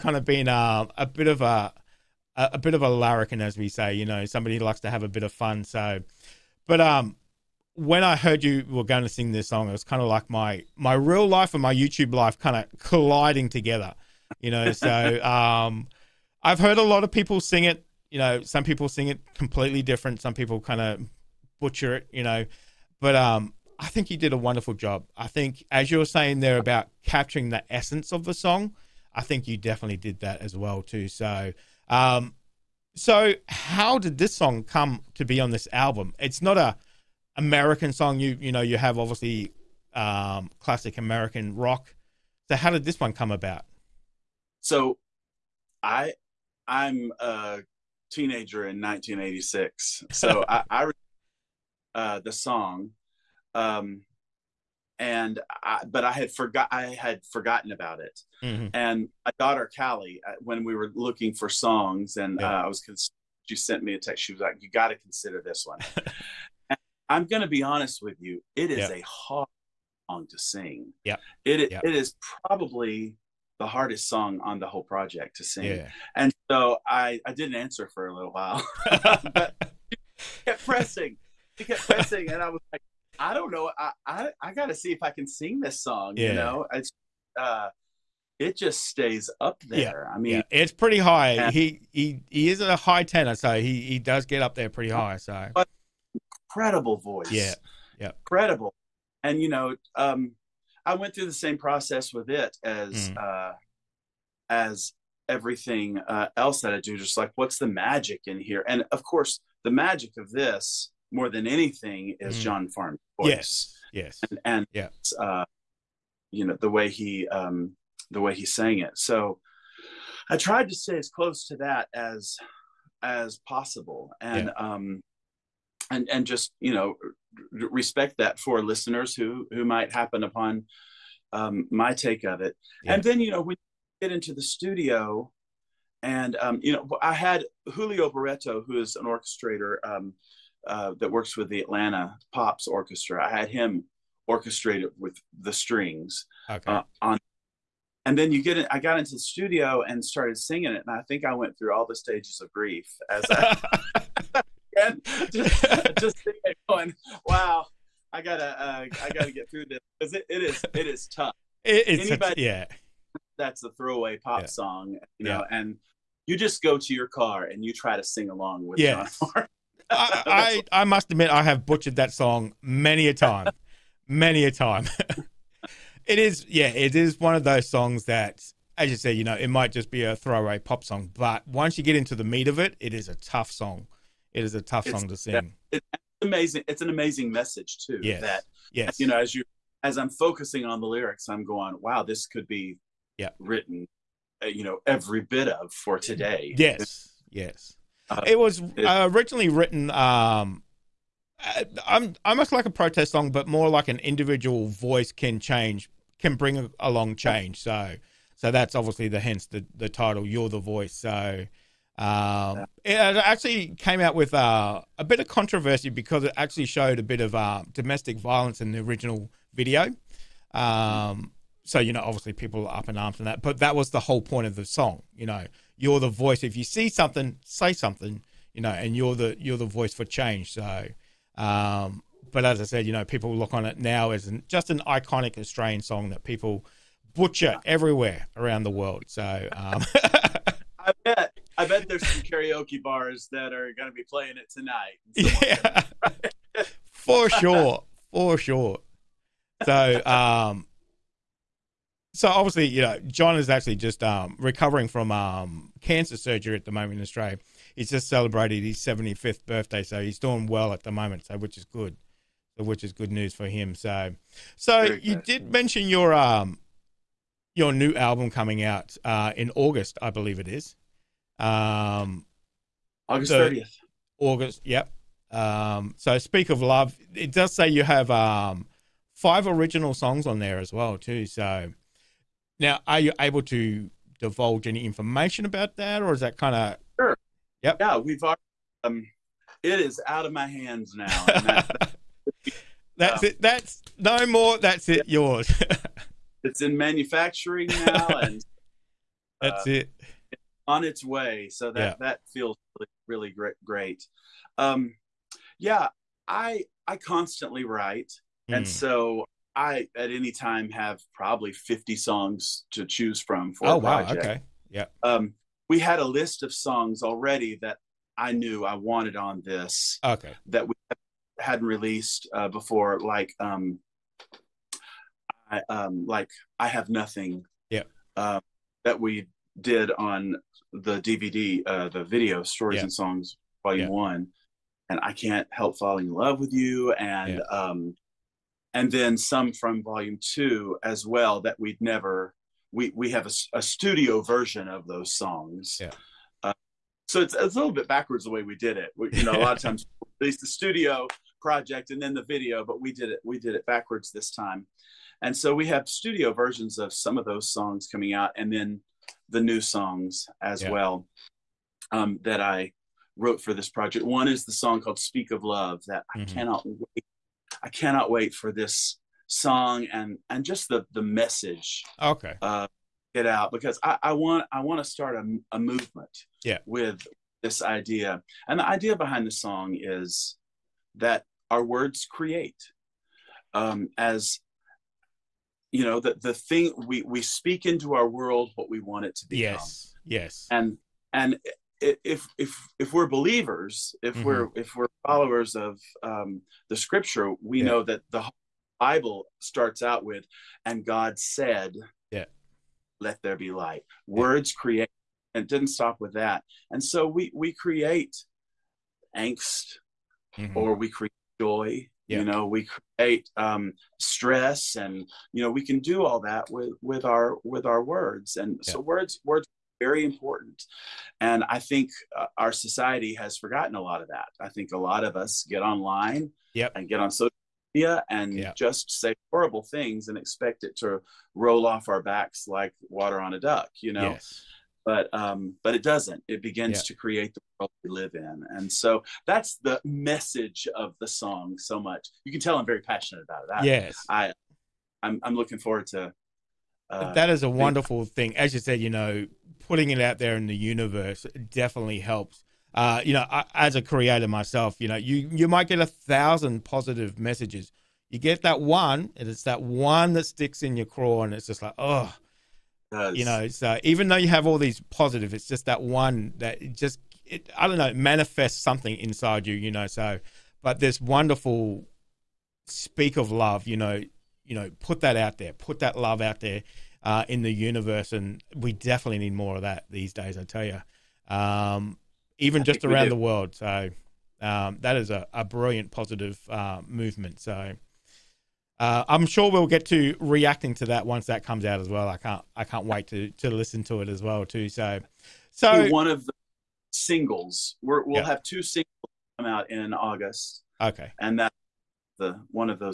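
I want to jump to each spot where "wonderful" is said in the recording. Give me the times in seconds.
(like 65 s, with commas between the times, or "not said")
24 s, 447 s, 471 s.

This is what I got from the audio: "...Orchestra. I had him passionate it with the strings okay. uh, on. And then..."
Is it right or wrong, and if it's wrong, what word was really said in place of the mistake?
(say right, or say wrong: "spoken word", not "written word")
wrong: "orchestrate", not "passionate".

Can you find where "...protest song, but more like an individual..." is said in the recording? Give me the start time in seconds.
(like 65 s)
202 s.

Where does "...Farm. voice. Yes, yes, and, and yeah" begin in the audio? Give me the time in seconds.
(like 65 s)
112 s.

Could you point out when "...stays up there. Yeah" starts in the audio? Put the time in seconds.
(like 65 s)
88 s.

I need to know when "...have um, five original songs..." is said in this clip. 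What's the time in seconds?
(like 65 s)
277 s.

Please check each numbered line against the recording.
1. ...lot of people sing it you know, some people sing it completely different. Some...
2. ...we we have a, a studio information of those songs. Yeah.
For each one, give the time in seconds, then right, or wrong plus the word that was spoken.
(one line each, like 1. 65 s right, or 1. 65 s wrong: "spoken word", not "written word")
1. 16 s right
2. 342 s wrong: "version", not "information".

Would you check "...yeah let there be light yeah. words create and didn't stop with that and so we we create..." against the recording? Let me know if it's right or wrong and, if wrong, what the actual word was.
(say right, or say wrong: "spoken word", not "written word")
right.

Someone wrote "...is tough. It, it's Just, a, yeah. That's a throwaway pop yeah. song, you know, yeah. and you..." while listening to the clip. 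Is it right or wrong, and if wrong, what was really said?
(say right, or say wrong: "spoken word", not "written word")
wrong: "Anybody", not "Just".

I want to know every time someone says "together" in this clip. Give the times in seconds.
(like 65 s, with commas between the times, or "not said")
13 s.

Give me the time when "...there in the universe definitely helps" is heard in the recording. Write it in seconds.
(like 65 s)
450 s.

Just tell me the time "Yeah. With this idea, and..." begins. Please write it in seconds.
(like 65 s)
376 s.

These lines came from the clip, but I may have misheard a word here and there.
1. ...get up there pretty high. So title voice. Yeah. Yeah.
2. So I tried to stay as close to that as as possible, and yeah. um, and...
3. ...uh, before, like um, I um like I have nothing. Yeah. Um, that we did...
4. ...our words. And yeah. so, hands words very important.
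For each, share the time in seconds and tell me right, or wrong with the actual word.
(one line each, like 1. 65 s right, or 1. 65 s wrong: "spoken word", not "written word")
1. 94 s wrong: "incredible", not "title"
2. 118 s right
3. 322 s right
4. 417 s wrong: "words", not "hands".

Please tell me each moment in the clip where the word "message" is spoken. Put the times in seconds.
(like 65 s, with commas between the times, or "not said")
187 s, 371 s, 439 s, 457 s.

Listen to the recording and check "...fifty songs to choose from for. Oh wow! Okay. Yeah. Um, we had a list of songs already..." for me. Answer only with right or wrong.
right.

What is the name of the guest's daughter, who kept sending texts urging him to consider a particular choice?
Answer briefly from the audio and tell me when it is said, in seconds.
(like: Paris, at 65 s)
Callie, at 59 s.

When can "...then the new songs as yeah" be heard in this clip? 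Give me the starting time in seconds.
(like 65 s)
358 s.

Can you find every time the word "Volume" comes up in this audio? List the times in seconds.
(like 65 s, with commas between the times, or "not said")
333 s, 339 s.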